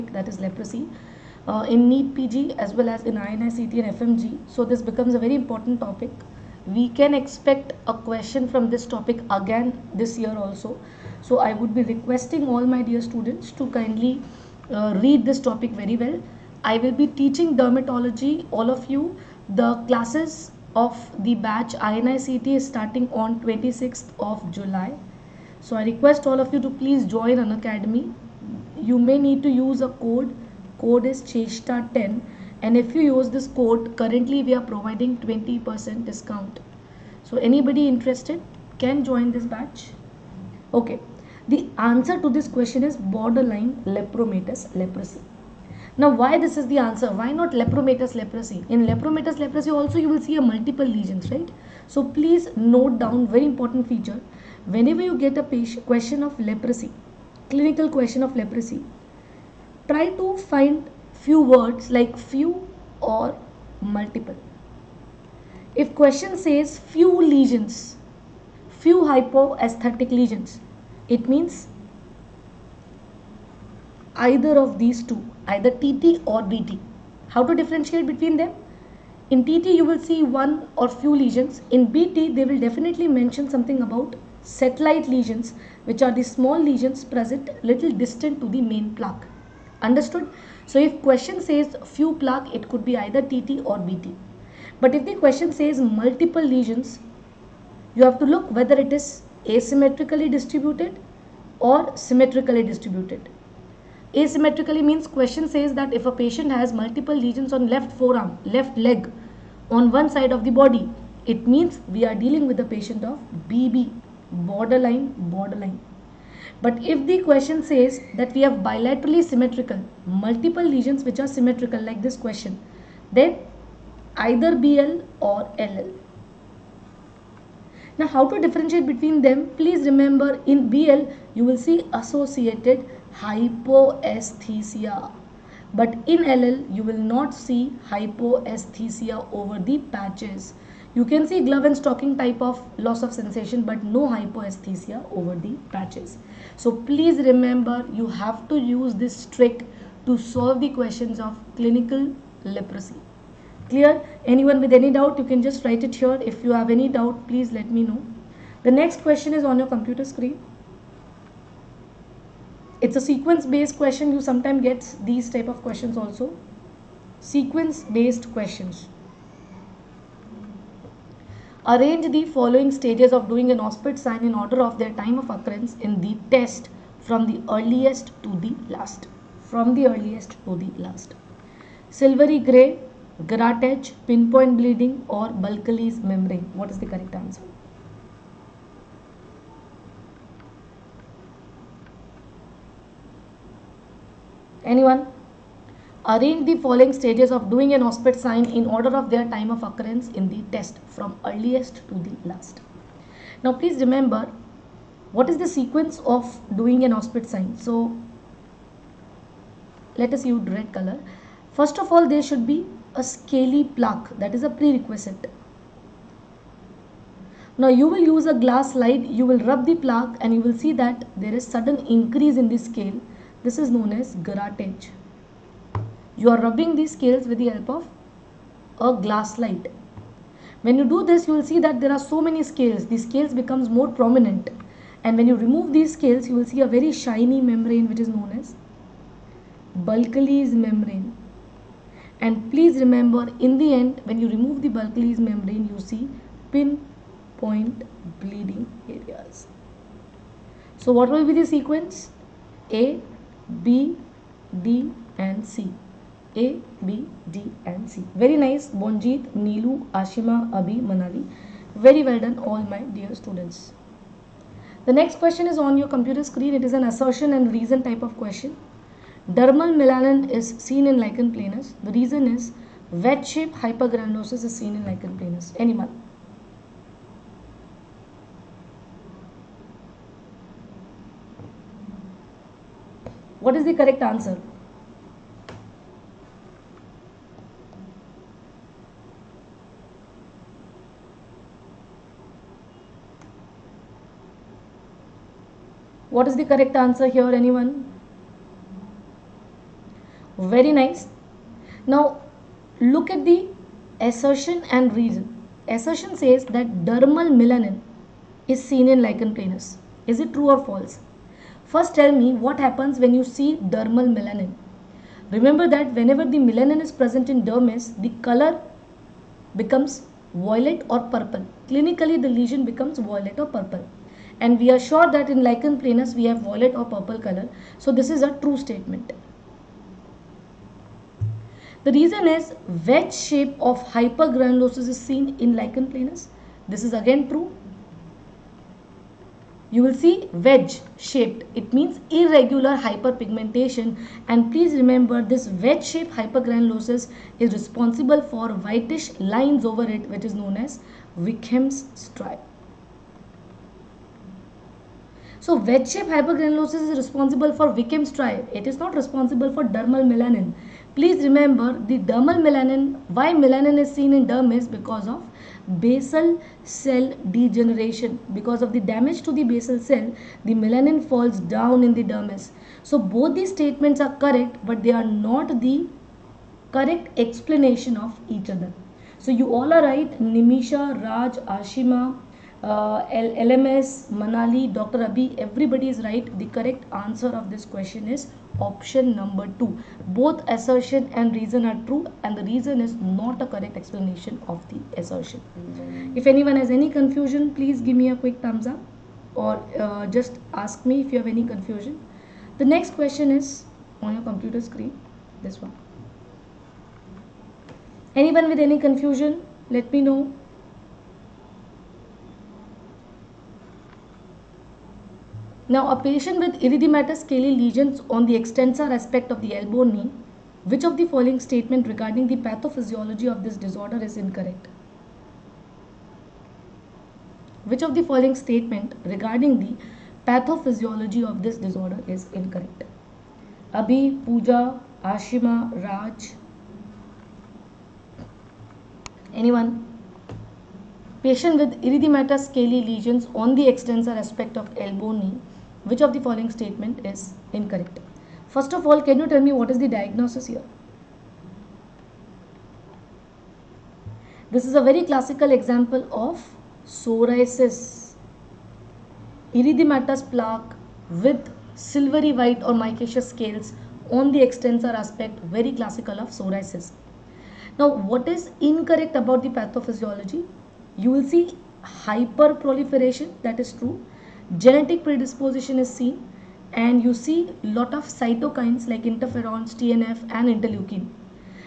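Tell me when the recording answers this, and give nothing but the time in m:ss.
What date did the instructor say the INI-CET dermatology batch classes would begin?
0:23.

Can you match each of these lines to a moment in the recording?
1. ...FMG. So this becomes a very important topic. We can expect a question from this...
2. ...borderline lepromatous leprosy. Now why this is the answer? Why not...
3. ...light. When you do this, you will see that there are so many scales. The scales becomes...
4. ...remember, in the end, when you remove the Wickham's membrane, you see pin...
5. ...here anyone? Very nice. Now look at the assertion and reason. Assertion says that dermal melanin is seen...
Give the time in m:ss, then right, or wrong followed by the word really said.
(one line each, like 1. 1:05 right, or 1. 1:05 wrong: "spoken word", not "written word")
1. 0:03 right
2. 0:42 right
3. 3:49 right
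4. 4:02 wrong: "Bulkley", not "Wickham"
5. 4:57 right.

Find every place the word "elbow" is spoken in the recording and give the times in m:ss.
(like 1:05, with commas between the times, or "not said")
6:59, 7:24.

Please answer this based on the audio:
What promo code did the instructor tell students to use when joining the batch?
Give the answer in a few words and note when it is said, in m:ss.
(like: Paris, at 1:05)
Chesta 10, at 0:31.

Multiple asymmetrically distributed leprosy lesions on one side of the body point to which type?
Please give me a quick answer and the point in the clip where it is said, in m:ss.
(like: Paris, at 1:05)
Borderline borderline, at 1:54.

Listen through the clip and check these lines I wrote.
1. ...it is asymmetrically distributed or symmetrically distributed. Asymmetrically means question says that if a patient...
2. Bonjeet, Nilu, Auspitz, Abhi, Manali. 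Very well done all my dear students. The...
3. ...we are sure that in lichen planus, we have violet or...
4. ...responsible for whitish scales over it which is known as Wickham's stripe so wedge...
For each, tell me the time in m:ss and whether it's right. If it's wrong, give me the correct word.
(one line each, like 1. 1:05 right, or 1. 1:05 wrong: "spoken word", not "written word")
1. 1:38 right
2. 4:18 wrong: "Ashima", not "Auspitz"
3. 5:24 right
4. 5:47 wrong: "lines", not "scales".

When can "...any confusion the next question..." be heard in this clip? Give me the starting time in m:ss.
6:41.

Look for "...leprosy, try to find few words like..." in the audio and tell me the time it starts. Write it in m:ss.
0:58.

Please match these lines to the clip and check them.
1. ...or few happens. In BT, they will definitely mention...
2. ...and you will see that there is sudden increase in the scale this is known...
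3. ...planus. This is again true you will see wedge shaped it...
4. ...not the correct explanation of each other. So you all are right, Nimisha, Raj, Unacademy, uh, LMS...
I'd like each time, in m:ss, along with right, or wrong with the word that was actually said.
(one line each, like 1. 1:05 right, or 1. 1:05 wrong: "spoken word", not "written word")
1. 1:20 wrong: "lesions", not "happens"
2. 3:40 right
3. 5:35 right
4. 6:15 wrong: "Ashima", not "Unacademy".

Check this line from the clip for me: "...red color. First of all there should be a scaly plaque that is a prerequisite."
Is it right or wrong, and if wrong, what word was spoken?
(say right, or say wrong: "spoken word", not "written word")
right.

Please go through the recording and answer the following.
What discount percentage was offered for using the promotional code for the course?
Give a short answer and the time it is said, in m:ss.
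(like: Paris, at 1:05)
20%, at 0:35.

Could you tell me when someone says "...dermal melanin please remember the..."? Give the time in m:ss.
5:59.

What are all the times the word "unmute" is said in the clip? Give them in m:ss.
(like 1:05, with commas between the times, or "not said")
not said.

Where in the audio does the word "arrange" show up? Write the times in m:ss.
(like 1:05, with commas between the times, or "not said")
2:51, 3:16.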